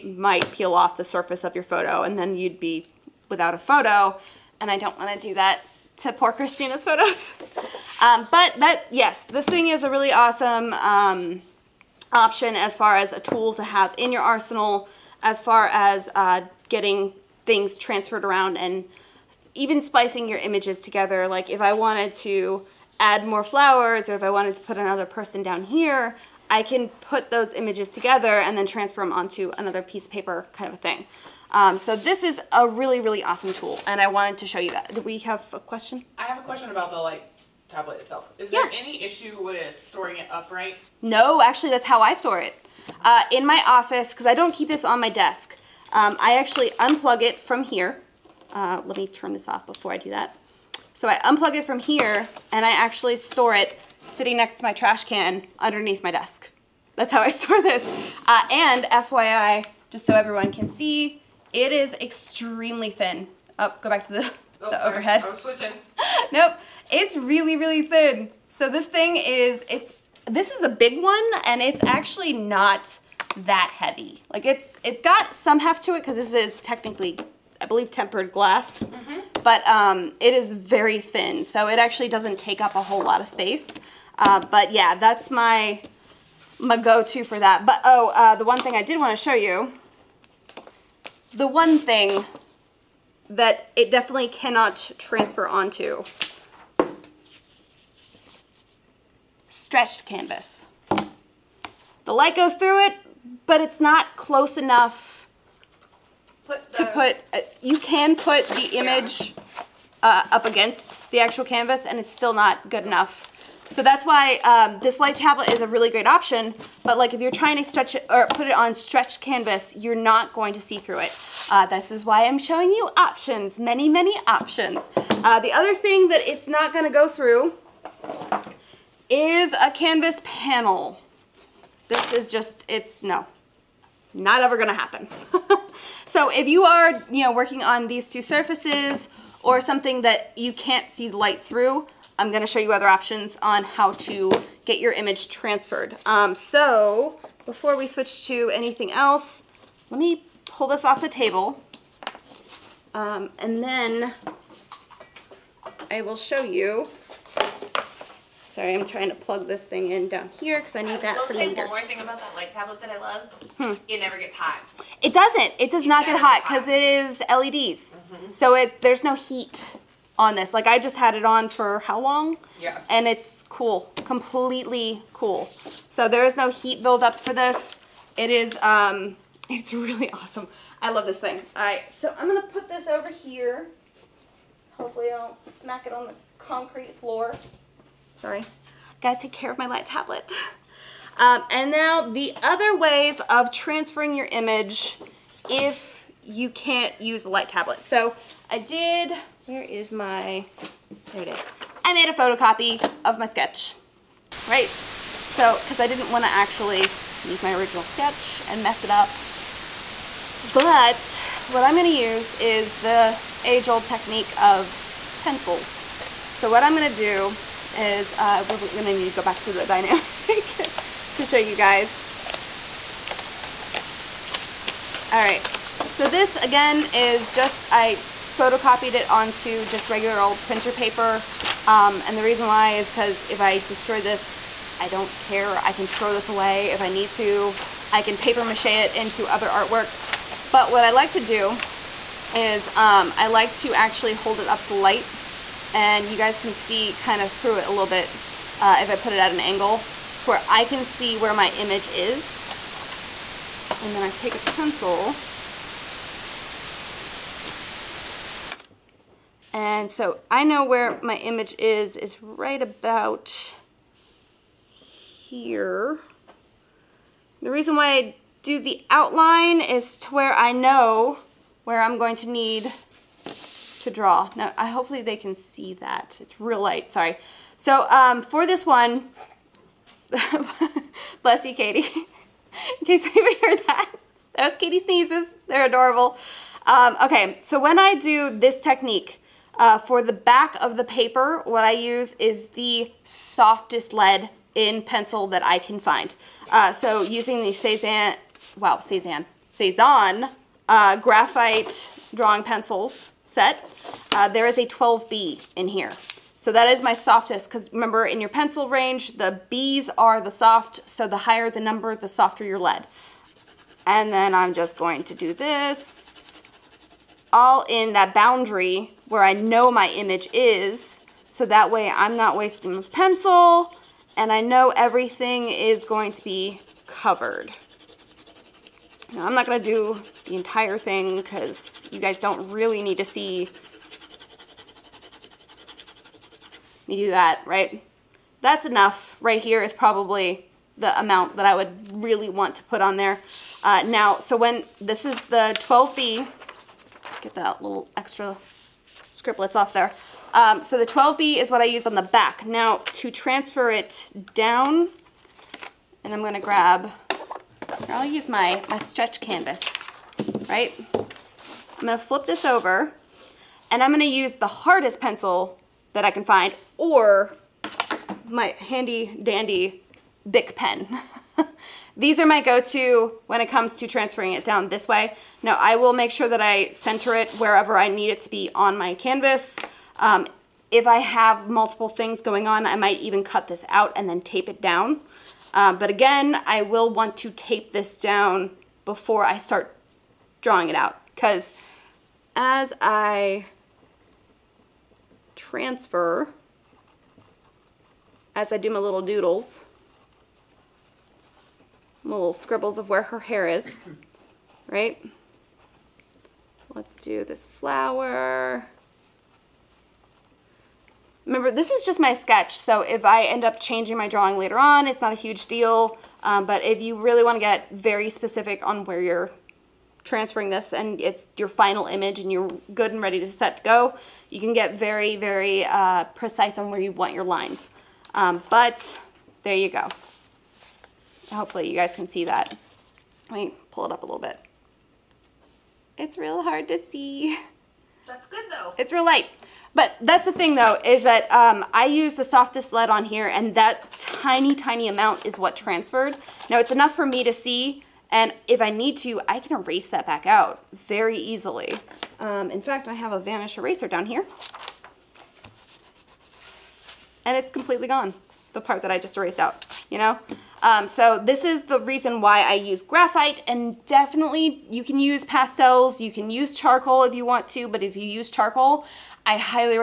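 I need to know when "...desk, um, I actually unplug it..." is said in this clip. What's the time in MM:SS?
00:45.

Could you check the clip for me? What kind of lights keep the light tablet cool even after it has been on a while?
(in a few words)
LEDs.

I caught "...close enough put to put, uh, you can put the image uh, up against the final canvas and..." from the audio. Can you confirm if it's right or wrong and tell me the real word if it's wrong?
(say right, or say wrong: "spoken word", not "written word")
wrong: "actual", not "final".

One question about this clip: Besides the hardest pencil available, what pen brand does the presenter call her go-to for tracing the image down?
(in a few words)
Bic.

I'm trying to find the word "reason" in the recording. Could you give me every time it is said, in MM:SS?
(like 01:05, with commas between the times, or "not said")
03:52, 04:27, 07:41.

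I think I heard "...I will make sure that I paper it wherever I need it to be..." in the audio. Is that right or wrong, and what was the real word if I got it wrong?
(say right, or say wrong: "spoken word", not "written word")
wrong: "center", not "paper".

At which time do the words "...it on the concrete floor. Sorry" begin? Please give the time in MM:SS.
03:05.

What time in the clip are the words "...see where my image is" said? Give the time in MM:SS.
04:10.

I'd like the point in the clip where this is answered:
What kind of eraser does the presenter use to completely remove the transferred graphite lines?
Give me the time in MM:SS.
07:33.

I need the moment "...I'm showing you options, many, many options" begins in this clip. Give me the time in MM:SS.
02:02.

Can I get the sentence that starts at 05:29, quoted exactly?
Now, I'm not gonna do the entire thing because you guys don't really need to see me do that, right?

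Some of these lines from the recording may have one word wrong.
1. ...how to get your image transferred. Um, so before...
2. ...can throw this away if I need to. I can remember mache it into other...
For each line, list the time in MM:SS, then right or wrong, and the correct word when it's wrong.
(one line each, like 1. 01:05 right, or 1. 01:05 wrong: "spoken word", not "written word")
1. 02:23 right
2. 03:55 wrong: "paper", not "remember".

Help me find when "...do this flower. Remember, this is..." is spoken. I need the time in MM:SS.
06:46.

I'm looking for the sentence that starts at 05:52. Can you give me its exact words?
Now to transfer it down, and I'm gonna grab, I'll use my, my stretch canvas right?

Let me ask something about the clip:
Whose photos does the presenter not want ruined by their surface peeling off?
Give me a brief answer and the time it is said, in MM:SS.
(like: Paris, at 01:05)
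Christina, at 00:06.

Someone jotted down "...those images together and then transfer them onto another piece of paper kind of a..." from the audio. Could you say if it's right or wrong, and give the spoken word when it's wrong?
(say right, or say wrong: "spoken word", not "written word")
right.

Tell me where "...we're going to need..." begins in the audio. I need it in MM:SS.
03:38.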